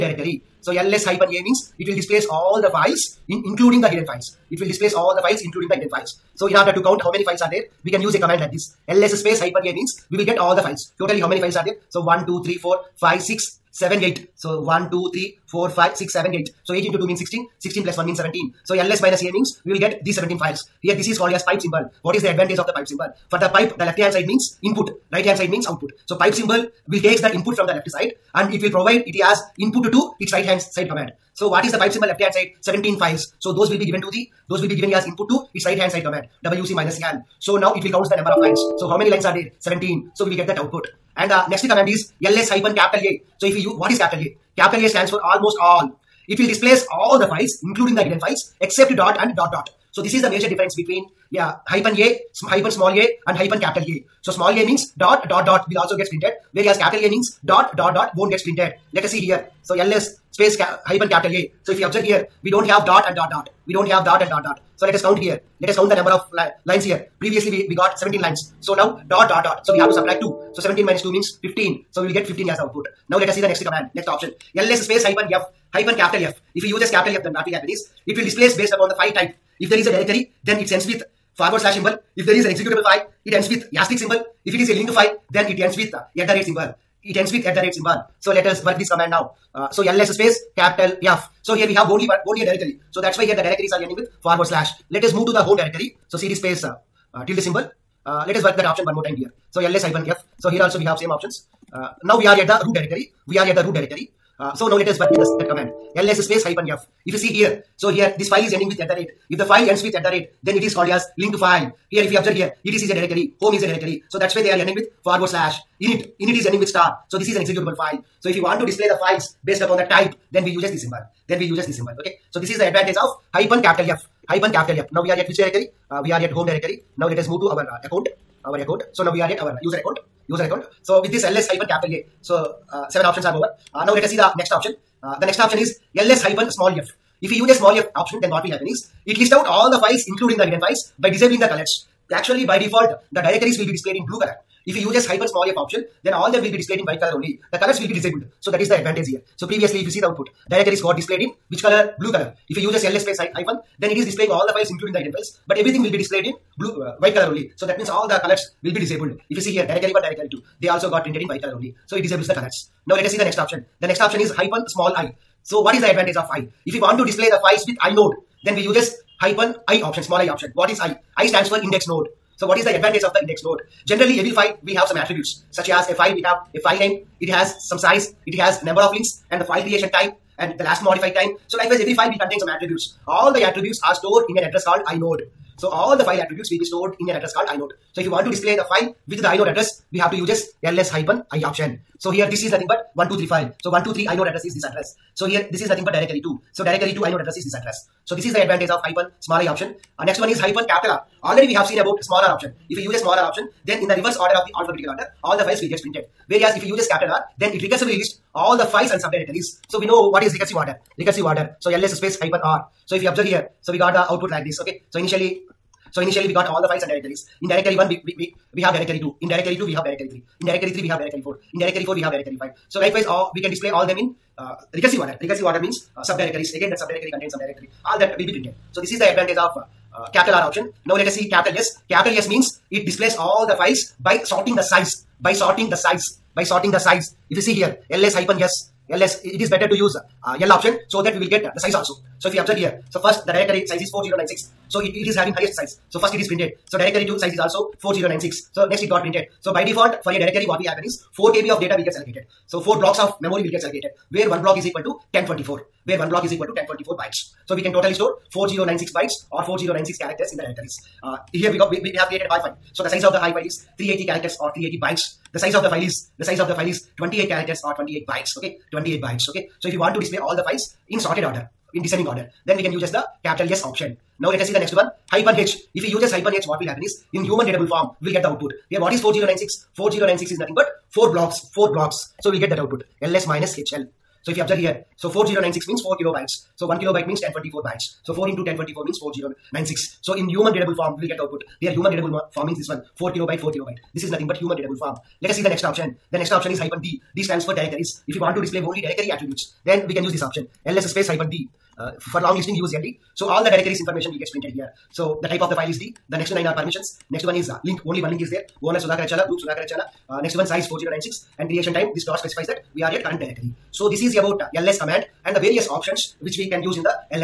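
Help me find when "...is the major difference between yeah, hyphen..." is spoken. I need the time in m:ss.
0:50.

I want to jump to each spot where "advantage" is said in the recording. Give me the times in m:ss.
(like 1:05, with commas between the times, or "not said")
0:22, 2:02, 2:28, 2:45, 2:52, 3:18, 3:49.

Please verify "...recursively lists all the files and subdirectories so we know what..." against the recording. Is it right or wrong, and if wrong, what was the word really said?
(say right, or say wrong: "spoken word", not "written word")
right.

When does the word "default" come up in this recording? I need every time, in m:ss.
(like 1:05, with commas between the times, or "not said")
2:22, 4:09.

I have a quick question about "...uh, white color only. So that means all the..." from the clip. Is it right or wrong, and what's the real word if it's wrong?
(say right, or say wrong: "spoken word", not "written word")
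right.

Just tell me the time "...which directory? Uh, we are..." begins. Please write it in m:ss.
2:05.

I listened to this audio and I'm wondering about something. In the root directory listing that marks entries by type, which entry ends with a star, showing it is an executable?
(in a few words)
init.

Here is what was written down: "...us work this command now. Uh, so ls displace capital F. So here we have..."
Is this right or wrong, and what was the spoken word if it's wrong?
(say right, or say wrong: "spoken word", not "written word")
wrong: "space", not "displace".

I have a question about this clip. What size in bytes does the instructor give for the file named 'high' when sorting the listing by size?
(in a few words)
380.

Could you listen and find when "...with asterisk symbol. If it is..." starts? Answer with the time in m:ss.
1:23.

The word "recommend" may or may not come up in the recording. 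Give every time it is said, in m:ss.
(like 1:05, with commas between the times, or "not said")
not said.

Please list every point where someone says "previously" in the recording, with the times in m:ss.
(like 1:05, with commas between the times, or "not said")
1:07, 2:29.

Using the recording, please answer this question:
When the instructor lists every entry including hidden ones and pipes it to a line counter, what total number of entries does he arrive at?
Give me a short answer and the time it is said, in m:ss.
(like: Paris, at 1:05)
17, at 0:17.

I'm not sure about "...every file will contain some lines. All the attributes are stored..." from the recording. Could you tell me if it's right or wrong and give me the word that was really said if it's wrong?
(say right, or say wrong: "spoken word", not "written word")
wrong: "attributes", not "lines".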